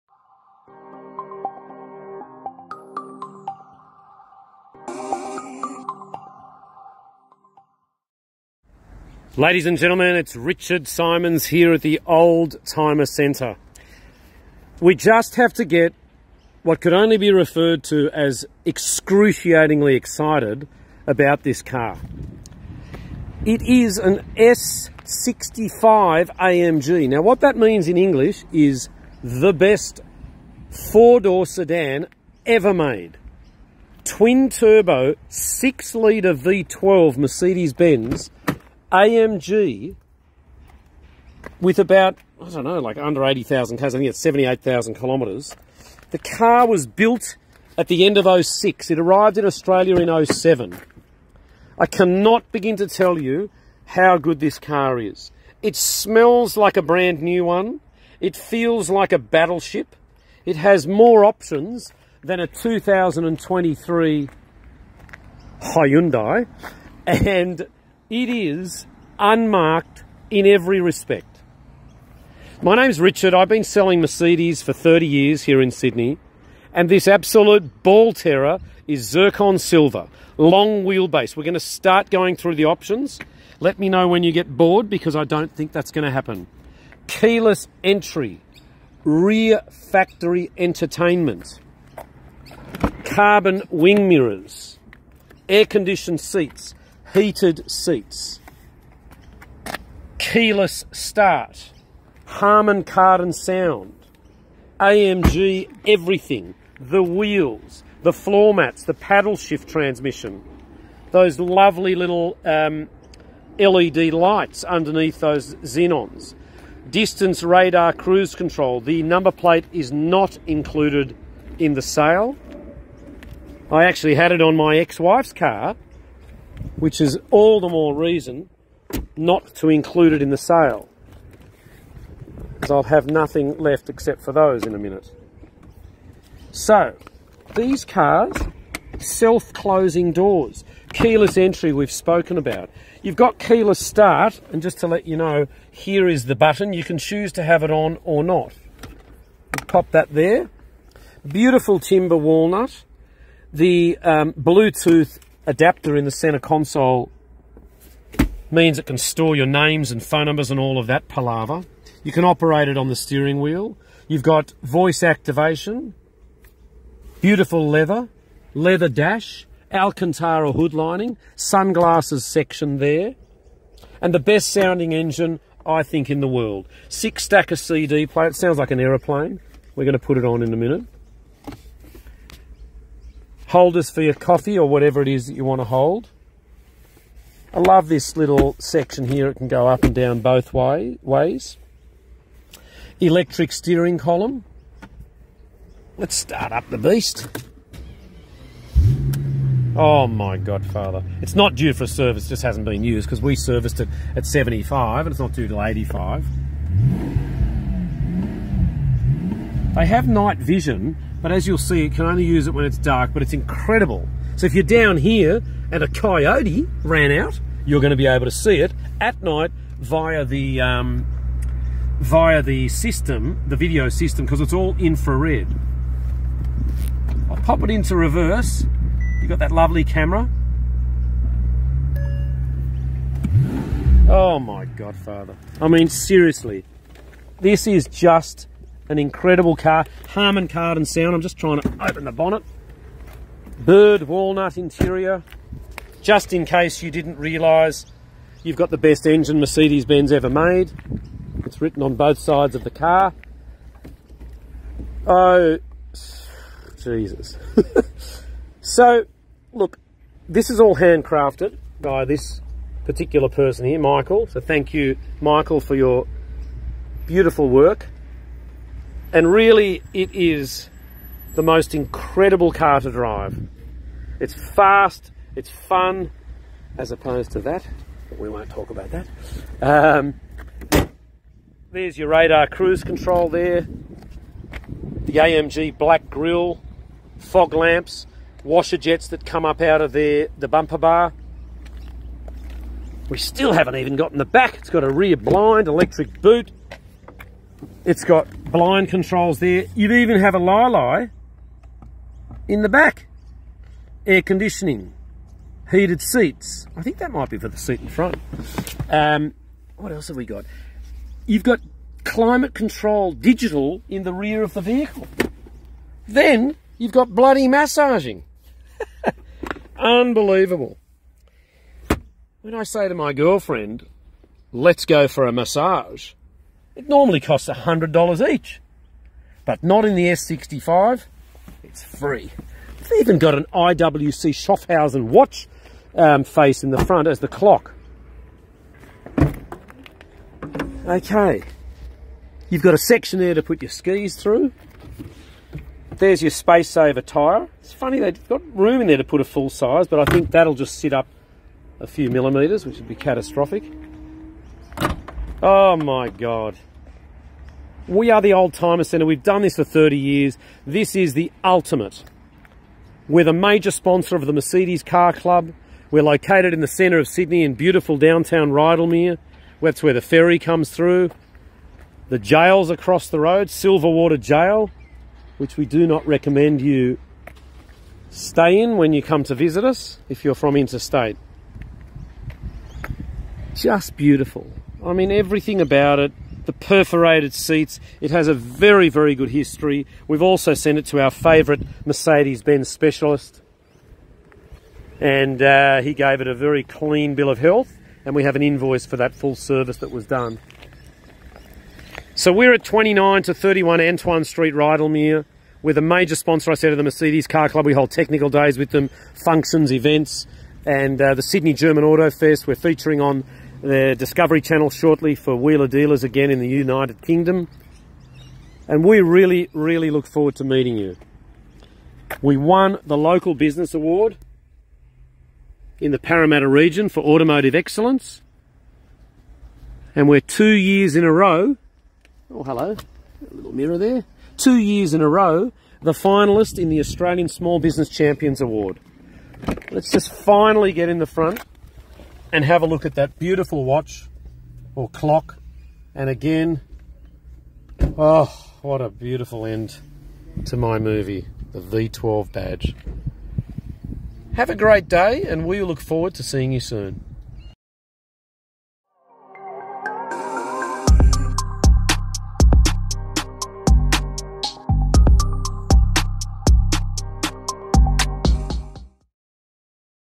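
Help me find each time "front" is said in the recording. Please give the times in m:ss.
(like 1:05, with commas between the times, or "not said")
5:07, 5:36, 7:21.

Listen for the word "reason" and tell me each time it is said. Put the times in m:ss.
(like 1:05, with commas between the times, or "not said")
2:07.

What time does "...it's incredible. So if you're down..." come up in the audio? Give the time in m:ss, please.
3:33.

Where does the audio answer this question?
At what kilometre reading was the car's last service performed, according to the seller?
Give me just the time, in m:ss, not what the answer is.
3:24.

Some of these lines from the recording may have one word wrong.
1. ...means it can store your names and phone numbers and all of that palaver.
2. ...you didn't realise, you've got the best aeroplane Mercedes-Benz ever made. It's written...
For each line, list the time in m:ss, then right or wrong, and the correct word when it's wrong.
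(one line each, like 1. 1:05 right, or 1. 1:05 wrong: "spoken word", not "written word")
1. 2:38 right
2. 4:06 wrong: "engine", not "aeroplane".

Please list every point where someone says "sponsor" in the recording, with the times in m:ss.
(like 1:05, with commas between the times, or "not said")
6:03, 6:46.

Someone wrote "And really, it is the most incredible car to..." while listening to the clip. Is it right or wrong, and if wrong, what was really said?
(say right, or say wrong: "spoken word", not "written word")
right.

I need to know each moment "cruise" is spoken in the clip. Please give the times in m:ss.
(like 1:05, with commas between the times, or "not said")
1:57, 4:42.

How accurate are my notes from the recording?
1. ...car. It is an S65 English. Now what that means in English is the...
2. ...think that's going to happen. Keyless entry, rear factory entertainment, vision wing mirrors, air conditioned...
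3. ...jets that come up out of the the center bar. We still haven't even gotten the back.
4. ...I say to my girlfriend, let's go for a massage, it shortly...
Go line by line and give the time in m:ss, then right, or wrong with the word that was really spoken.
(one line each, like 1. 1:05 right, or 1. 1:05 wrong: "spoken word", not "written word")
1. 0:21 wrong: "AMG", not "English"
2. 1:25 wrong: "carbon", not "vision"
3. 4:48 wrong: "bumper", not "center"
4. 5:22 wrong: "normally", not "shortly".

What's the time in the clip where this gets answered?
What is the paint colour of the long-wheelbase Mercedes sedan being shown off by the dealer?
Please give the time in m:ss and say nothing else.
1:19.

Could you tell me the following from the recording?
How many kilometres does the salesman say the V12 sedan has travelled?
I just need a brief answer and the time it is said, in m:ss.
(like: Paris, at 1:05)
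78,000, at 0:44.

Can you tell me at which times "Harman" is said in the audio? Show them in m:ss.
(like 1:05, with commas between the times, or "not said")
1:42, 4:00.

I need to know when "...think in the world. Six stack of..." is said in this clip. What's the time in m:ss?
2:55.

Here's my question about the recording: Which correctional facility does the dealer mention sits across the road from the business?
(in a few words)
Silverwater Jail.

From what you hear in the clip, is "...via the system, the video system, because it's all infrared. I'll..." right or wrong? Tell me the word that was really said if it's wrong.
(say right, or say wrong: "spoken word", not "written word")
right.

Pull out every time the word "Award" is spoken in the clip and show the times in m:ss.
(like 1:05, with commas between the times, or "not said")
7:03, 7:18.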